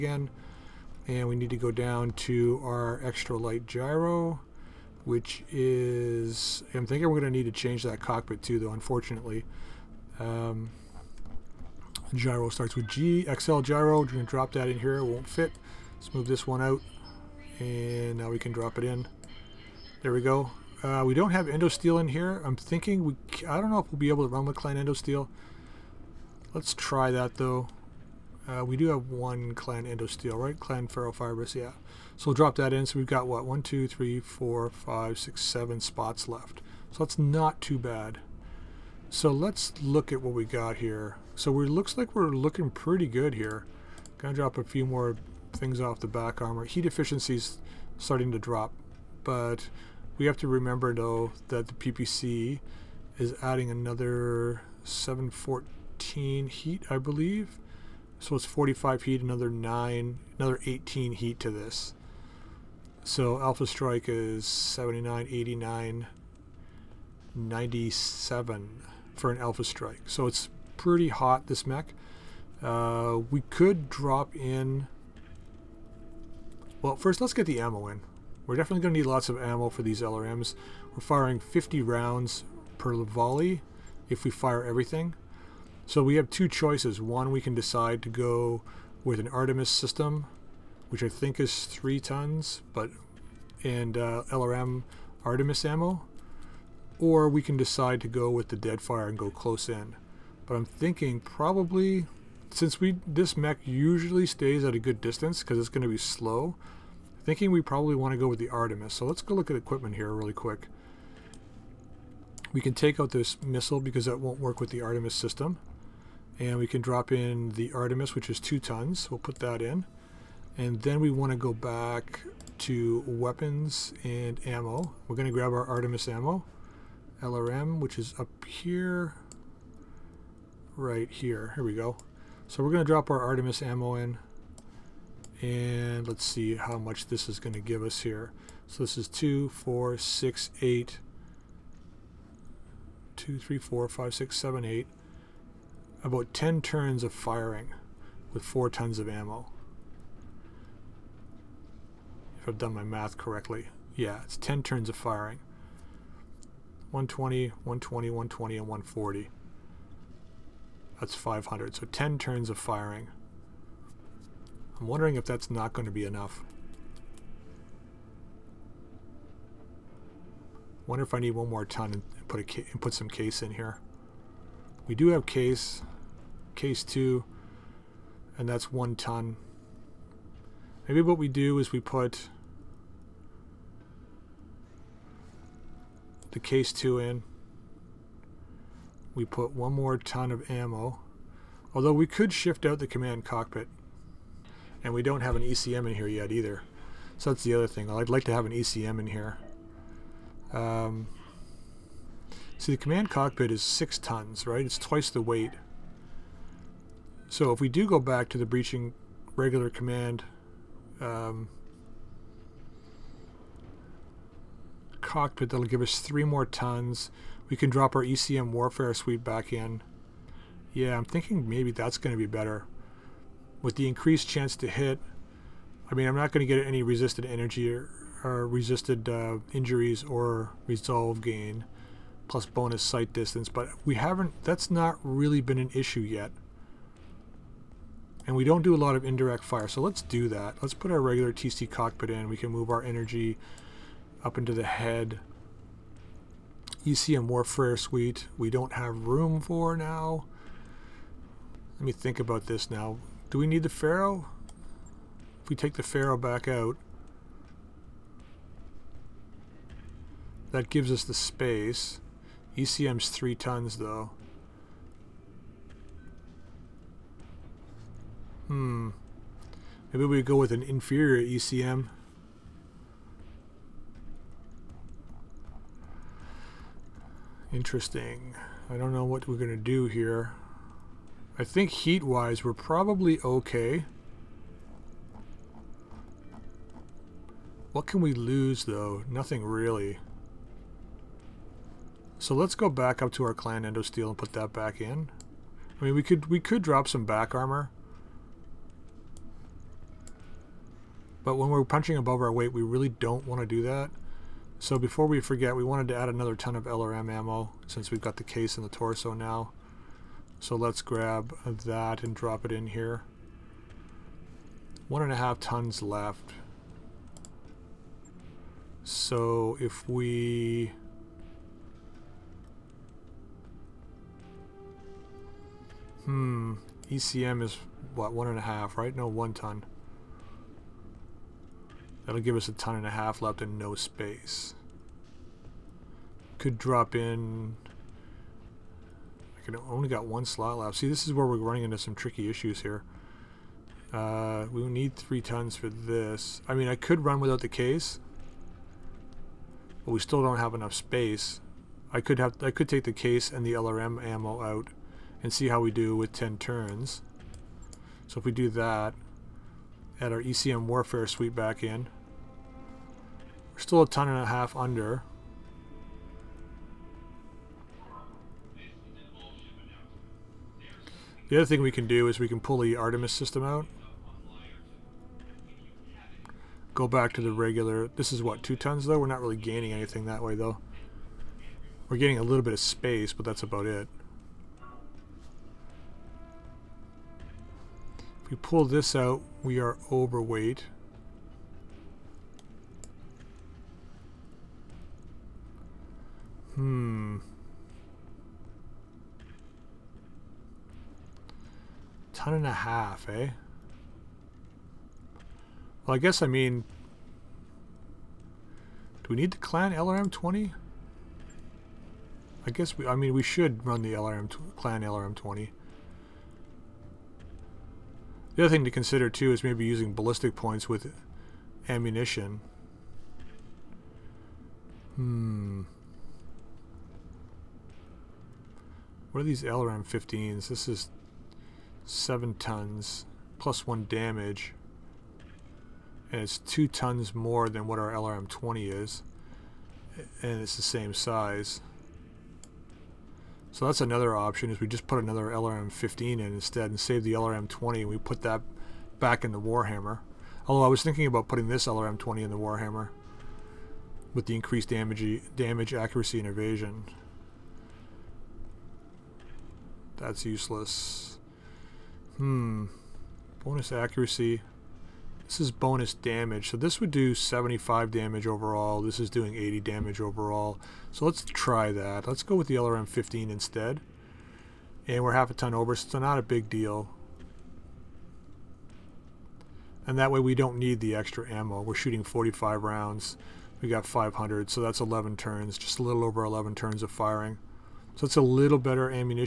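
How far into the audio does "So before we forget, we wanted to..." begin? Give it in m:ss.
5:04.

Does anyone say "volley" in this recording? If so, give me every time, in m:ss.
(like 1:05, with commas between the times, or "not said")
1:22.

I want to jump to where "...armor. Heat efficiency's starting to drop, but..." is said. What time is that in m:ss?
0:46.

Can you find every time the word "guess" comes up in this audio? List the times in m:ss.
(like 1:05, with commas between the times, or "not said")
6:45, 6:52.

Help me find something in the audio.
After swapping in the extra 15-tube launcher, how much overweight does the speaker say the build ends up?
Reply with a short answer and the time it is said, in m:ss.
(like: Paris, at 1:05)
half a ton, at 7:55.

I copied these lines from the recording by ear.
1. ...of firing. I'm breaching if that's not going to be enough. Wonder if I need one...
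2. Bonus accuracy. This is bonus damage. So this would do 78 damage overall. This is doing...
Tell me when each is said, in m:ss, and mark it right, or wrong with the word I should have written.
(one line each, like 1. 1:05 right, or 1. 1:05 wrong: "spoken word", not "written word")
1. 2:42 wrong: "wondering", not "breaching"
2. 7:43 wrong: "75", not "78".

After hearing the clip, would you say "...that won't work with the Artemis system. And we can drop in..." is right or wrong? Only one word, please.
right.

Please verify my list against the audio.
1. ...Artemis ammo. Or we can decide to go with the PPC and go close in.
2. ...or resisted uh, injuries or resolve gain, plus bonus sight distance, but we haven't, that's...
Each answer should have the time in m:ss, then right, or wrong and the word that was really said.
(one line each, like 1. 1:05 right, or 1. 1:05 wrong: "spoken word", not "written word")
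1. 1:35 wrong: "Deadfire", not "PPC"
2. 3:48 right.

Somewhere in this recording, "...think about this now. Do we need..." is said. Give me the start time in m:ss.
4:11.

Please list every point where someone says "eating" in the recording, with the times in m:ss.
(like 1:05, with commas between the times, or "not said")
not said.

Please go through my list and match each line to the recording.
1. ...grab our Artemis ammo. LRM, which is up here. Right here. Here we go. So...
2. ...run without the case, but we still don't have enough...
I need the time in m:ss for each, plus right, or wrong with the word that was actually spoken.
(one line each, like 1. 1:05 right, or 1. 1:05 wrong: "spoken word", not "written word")
1. 2:05 right
2. 5:47 right.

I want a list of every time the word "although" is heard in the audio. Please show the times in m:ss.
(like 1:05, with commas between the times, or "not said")
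3:11, 7:30.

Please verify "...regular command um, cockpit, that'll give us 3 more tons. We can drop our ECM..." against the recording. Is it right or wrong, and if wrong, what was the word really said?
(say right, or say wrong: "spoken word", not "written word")
right.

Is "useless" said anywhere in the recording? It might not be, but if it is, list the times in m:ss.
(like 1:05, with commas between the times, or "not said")
7:40.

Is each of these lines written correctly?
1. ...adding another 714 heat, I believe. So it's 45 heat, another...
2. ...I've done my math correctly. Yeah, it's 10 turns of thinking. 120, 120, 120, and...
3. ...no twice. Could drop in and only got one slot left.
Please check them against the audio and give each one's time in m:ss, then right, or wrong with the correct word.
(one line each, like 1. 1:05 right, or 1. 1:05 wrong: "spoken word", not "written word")
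1. 0:53 right
2. 2:32 wrong: "firing", not "thinking"
3. 5:33 wrong: "space", not "twice".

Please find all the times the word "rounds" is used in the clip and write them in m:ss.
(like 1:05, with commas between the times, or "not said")
1:21, 8:02.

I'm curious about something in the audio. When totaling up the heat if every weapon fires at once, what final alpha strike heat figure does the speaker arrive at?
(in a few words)
97.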